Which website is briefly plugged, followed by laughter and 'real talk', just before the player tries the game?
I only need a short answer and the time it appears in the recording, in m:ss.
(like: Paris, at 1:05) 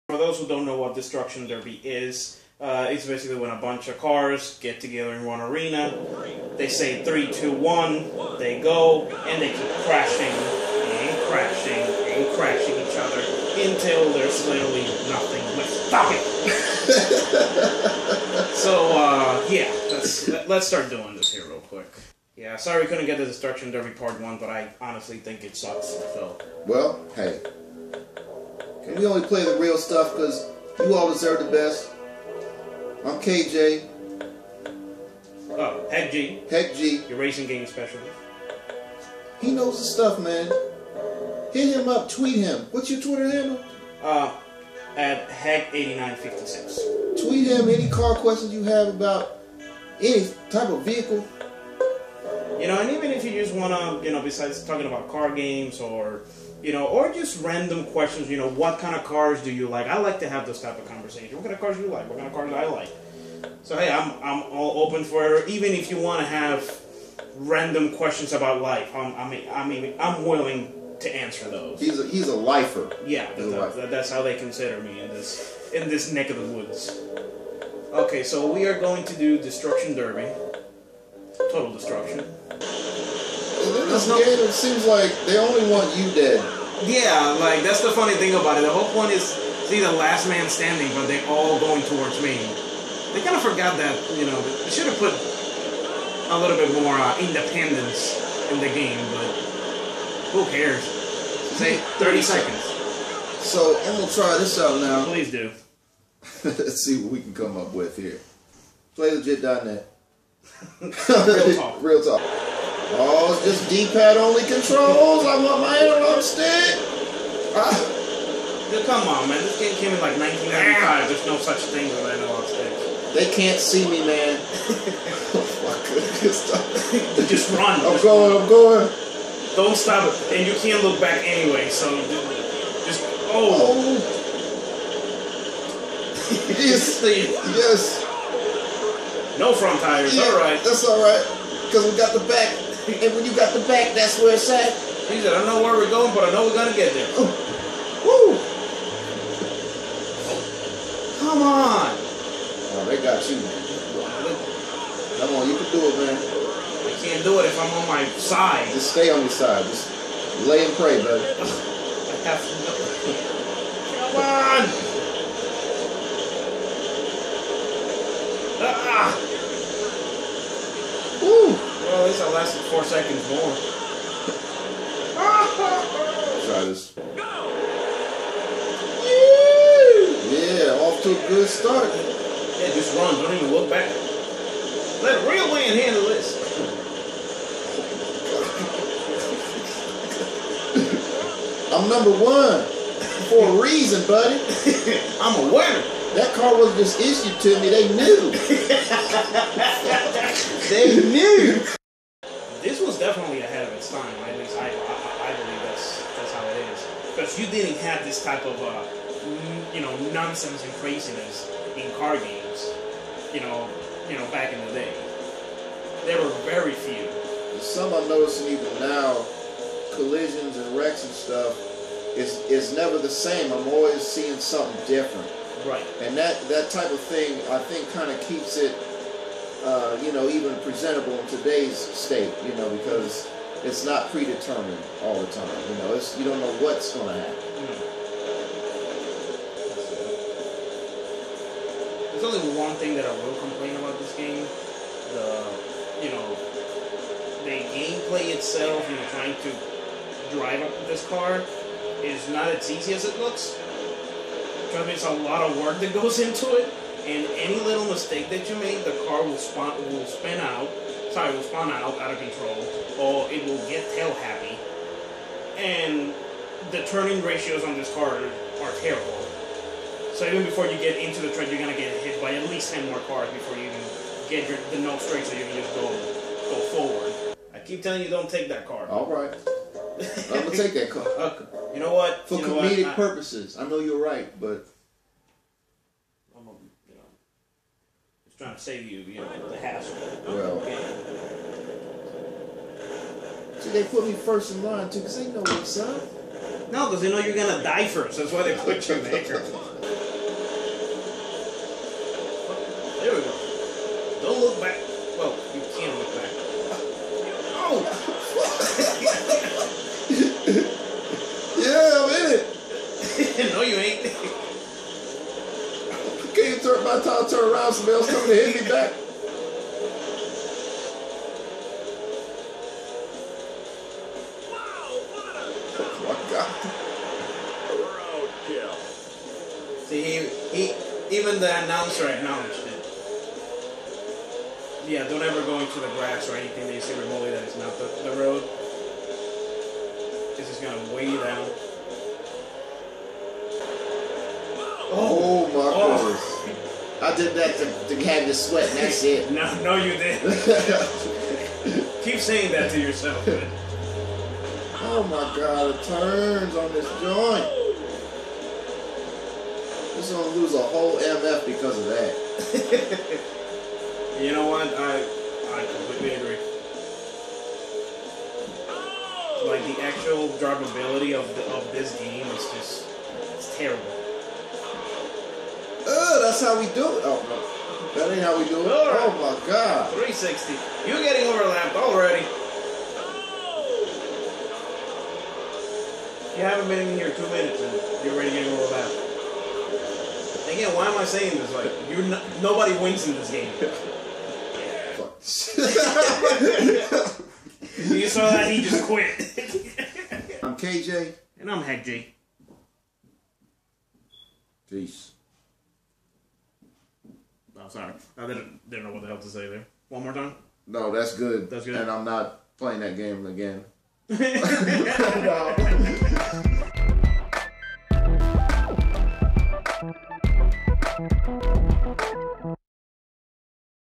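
PlayLegit.net, at 1:48.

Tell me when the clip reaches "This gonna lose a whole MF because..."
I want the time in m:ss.
5:59.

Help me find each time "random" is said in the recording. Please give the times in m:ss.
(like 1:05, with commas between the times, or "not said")
0:57, 1:07.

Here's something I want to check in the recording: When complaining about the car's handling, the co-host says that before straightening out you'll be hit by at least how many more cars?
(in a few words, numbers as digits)
10.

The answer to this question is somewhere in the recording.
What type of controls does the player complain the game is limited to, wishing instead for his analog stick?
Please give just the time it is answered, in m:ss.
1:53.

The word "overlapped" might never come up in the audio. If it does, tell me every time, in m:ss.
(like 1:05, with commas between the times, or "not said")
6:21, 6:28.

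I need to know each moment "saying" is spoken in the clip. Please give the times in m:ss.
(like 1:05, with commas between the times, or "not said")
5:52, 6:31.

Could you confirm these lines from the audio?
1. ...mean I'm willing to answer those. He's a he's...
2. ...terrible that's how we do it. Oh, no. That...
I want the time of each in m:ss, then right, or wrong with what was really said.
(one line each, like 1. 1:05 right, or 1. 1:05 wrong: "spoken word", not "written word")
1. 1:09 right
2. 6:13 right.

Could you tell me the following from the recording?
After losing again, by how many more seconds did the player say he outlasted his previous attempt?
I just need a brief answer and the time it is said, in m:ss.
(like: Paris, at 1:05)
4 seconds, at 2:52.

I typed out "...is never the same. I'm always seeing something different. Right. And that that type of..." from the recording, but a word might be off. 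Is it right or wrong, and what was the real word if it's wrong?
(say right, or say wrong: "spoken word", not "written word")
right.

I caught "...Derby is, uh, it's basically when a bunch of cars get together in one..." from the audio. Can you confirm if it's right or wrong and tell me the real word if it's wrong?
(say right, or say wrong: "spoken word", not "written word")
right.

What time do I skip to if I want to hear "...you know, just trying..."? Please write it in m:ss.
4:46.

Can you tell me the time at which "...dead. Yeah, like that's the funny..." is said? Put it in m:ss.
1:26.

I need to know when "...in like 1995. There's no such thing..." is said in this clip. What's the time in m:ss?
1:59.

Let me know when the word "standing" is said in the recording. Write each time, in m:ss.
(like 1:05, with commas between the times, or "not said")
1:30.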